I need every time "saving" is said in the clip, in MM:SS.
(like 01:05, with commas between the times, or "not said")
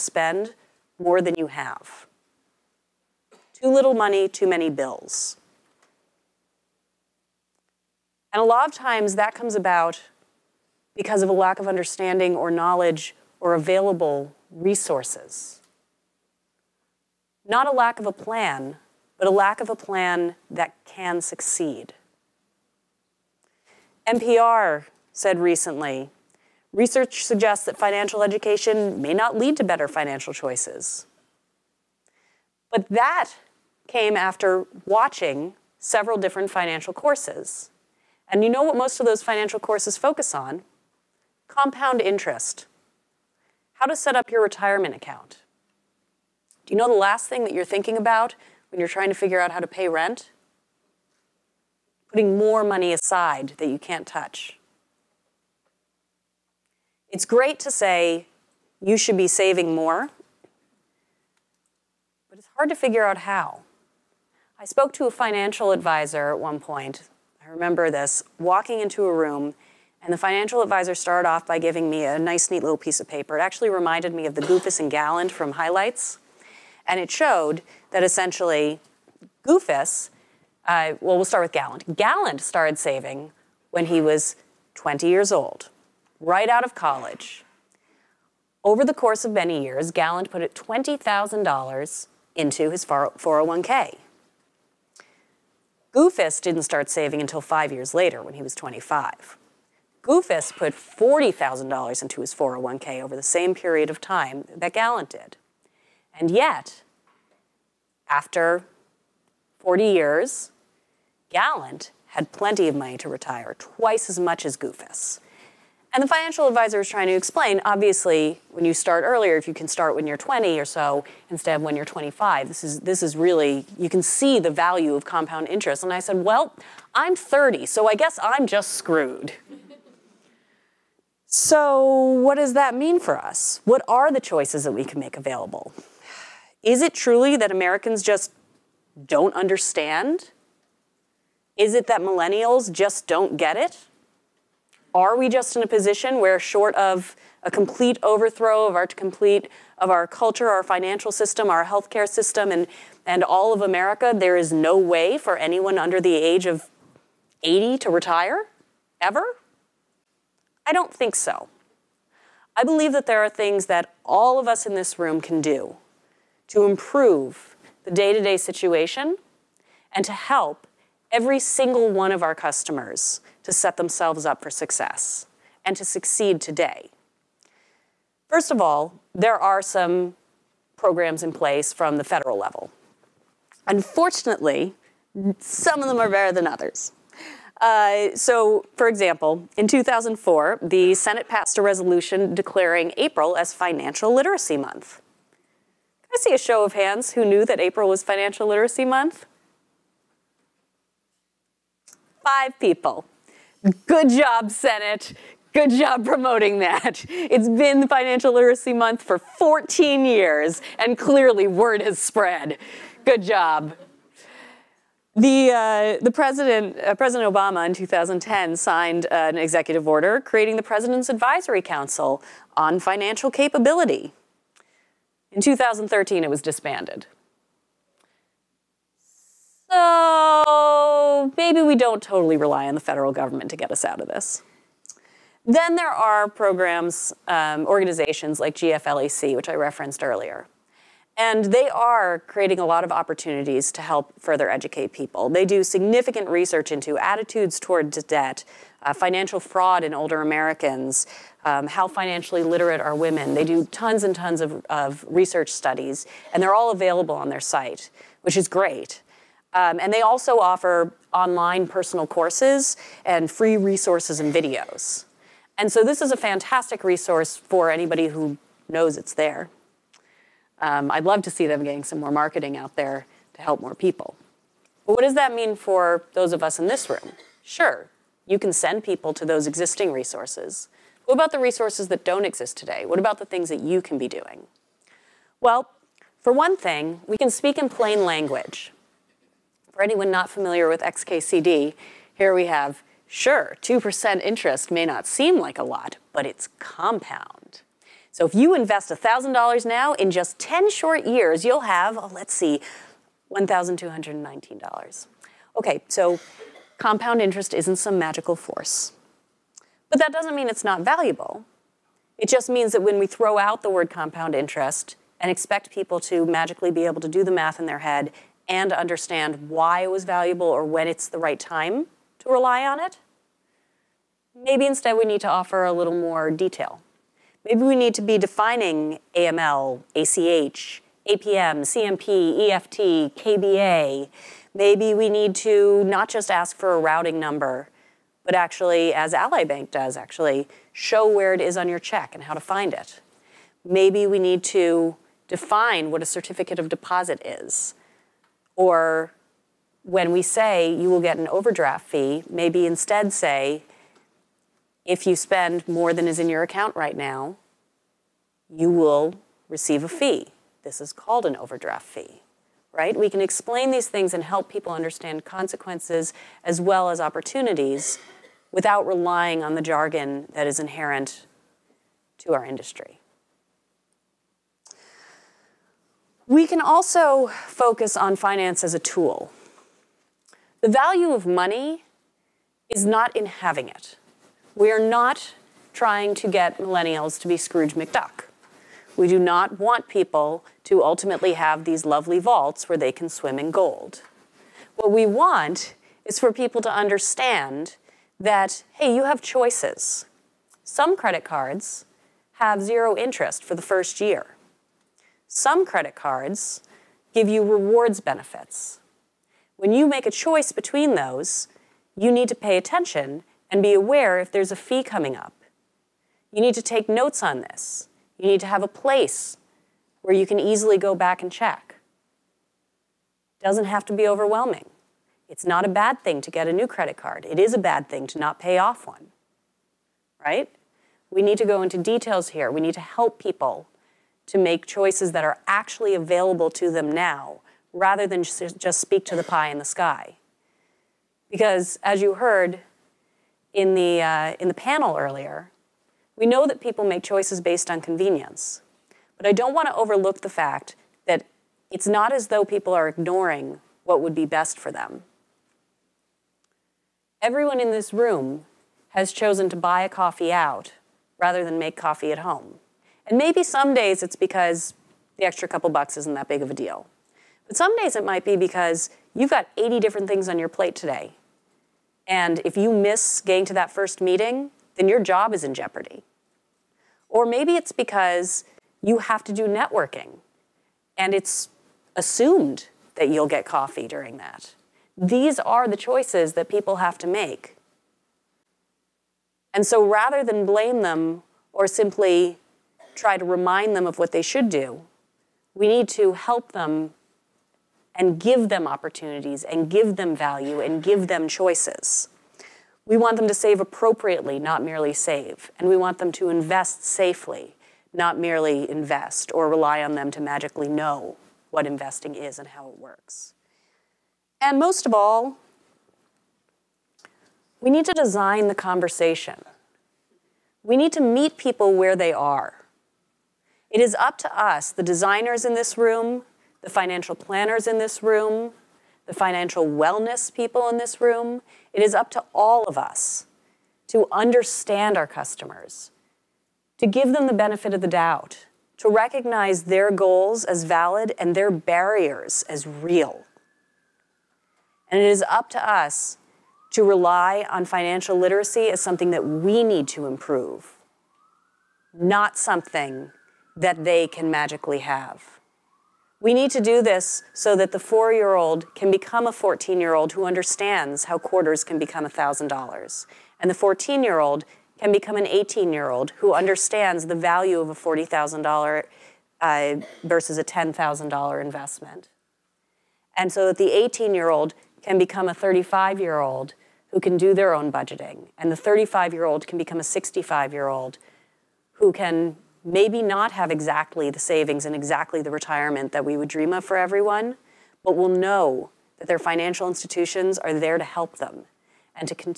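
00:59, 01:22, 01:36, 09:44.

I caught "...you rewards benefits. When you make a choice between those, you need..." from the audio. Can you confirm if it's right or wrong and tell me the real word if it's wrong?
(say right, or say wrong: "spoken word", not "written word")
right.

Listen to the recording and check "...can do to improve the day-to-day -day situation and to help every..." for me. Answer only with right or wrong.
right.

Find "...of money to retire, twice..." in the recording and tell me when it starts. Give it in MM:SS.
01:52.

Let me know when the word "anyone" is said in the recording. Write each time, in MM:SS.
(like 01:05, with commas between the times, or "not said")
02:35, 04:49.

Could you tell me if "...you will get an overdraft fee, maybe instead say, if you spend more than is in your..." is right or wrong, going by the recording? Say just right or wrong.
right.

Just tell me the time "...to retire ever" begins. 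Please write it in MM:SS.
02:37.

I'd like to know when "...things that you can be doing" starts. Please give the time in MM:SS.
04:43.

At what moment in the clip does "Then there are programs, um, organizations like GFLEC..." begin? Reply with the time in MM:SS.
03:55.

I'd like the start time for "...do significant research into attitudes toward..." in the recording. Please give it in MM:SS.
04:05.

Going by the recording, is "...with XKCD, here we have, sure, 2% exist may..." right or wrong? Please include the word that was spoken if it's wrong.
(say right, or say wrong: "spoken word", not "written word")
wrong: "interest", not "exist".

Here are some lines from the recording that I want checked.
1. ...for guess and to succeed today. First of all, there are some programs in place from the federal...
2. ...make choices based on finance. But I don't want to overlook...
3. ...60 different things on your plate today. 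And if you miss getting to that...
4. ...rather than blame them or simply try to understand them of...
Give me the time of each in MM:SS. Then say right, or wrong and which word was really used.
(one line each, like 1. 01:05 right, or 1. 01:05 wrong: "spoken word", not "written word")
1. 02:54 wrong: "success", not "guess"
2. 07:26 wrong: "convenience", not "finance"
3. 07:49 wrong: "80", not "60"
4. 08:09 wrong: "remind", not "understand".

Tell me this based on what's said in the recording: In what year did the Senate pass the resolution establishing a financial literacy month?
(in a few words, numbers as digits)
2004.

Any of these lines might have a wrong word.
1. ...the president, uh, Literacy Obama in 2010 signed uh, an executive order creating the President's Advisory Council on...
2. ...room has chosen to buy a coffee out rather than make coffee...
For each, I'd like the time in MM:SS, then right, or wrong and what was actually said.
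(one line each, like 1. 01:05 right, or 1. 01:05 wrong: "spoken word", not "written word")
1. 03:36 wrong: "President", not "Literacy"
2. 07:37 right.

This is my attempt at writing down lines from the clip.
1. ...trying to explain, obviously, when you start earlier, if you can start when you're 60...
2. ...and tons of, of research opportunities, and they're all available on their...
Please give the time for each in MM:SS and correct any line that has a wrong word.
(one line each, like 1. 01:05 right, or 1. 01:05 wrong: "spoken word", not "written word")
1. 01:56 wrong: "20", not "60"
2. 04:14 wrong: "studies", not "opportunities".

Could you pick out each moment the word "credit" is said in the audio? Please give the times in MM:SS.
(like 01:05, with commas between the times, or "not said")
06:40, 06:45, 07:06.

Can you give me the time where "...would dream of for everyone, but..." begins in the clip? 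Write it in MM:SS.
09:46.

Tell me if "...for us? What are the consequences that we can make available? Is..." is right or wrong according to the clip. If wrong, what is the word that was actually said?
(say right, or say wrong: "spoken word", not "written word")
wrong: "choices", not "consequences".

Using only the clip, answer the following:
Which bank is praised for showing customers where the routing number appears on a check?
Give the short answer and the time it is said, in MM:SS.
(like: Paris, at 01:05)
Ally Bank, at 05:39.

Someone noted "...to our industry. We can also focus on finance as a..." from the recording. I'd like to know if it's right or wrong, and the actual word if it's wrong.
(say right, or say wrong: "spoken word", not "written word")
right.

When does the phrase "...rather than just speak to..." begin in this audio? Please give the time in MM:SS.
07:17.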